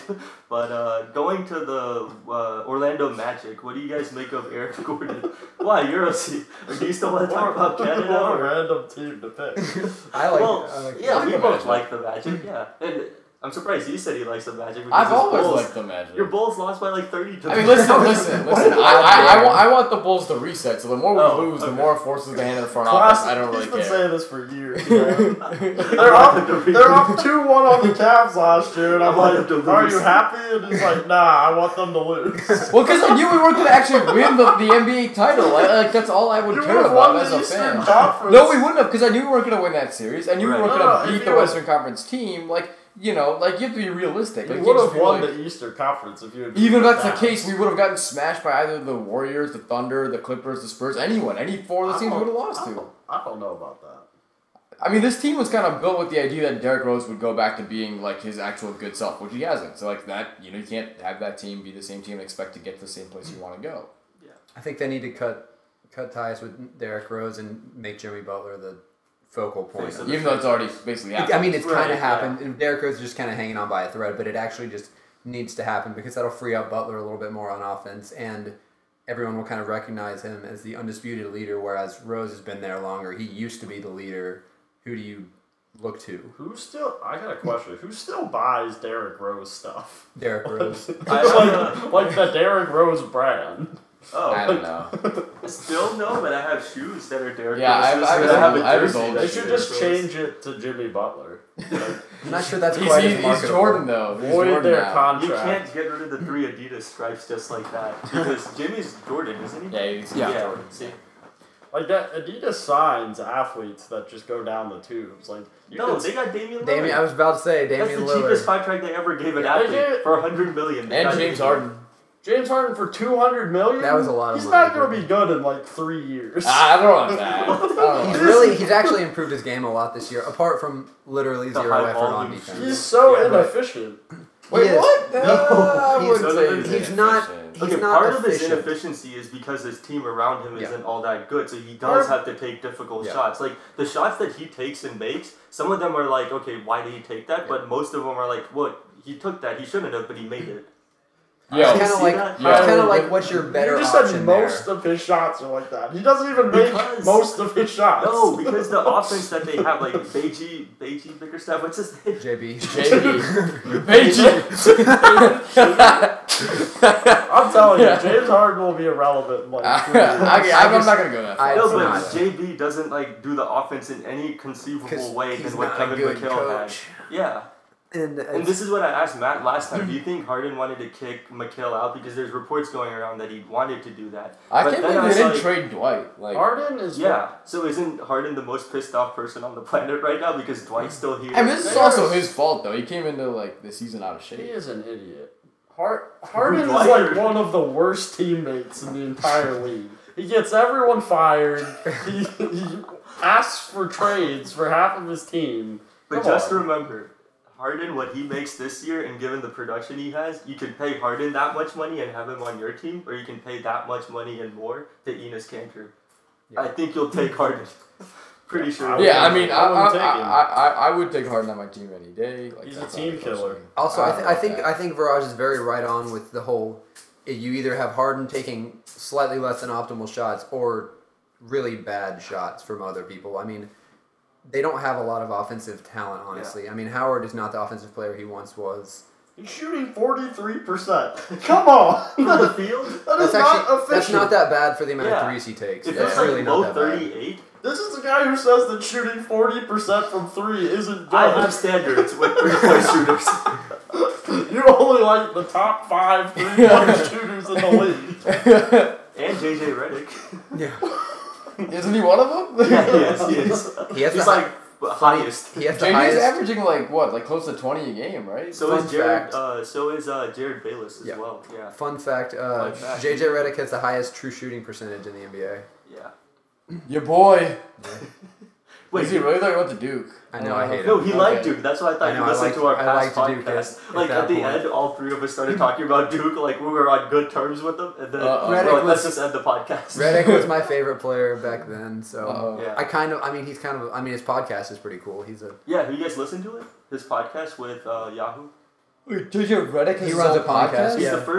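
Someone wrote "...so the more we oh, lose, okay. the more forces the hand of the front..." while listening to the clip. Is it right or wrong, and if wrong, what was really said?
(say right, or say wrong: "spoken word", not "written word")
right.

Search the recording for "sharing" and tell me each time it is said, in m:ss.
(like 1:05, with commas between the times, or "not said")
not said.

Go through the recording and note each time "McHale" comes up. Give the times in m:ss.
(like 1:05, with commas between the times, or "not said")
2:55, 3:01.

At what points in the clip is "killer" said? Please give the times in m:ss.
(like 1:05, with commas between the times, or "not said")
3:43.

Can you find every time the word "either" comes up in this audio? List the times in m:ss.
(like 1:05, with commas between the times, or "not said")
0:48, 3:47.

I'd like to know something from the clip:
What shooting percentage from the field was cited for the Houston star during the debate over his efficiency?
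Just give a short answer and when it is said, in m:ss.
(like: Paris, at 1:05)
43%, at 3:59.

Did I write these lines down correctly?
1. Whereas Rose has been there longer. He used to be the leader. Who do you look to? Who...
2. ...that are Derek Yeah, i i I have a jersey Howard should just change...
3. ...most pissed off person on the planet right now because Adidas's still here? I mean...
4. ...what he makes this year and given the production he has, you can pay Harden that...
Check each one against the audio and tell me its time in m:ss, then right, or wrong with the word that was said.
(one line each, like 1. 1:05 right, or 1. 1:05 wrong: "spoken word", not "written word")
1. 1:21 right
2. 1:37 wrong: "They", not "Howard"
3. 3:08 wrong: "Dwight", not "Adidas"
4. 3:27 right.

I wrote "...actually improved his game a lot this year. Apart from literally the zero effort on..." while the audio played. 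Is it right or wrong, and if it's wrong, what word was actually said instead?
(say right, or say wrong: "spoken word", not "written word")
right.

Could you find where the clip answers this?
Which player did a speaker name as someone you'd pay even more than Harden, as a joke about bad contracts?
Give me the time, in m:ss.
3:35.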